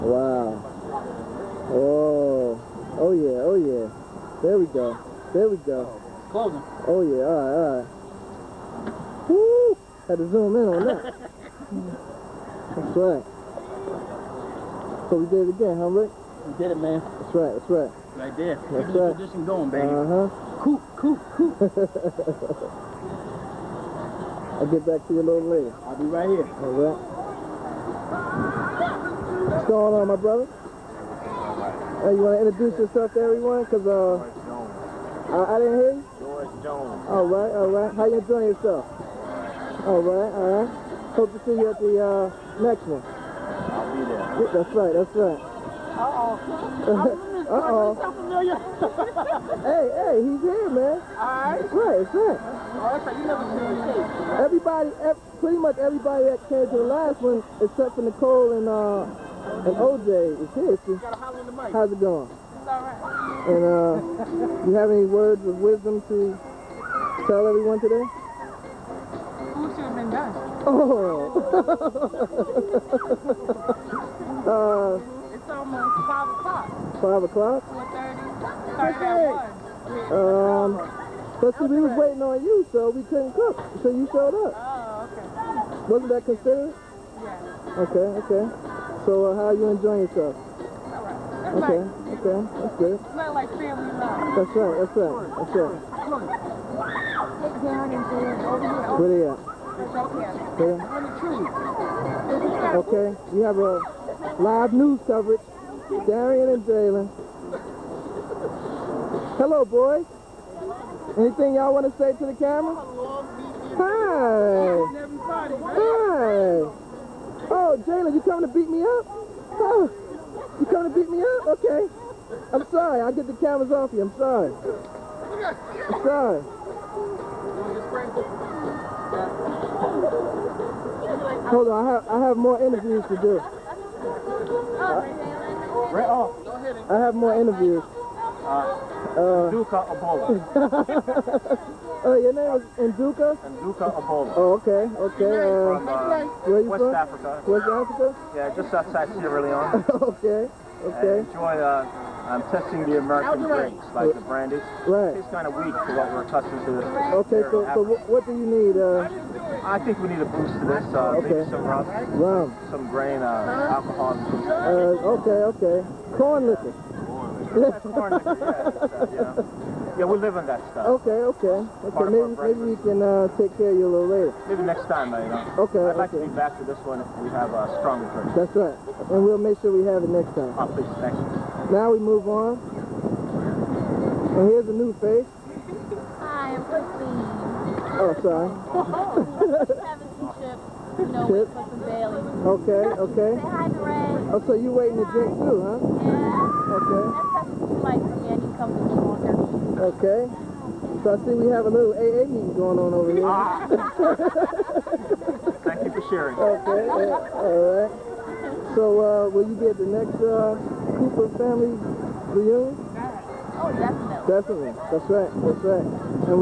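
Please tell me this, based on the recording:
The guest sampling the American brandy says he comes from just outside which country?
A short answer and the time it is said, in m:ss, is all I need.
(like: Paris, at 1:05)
Sierra Leone, at 2:29.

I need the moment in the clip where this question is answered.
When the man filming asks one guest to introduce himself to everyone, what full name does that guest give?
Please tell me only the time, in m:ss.
0:36.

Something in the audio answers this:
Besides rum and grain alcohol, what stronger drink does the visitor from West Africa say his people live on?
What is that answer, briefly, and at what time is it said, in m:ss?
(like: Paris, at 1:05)
Corn liquor, at 2:46.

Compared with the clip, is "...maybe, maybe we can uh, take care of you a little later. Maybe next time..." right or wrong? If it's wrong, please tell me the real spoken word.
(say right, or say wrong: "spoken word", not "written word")
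right.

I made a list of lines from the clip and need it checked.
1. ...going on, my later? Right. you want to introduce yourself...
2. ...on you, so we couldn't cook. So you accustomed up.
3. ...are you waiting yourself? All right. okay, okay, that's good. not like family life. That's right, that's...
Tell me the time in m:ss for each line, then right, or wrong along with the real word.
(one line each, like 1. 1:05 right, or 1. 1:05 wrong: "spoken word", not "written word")
1. 0:29 wrong: "brother", not "later"
2. 1:22 wrong: "showed", not "accustomed"
3. 1:29 wrong: "enjoying", not "waiting".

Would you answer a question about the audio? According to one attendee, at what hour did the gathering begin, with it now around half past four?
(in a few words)
1.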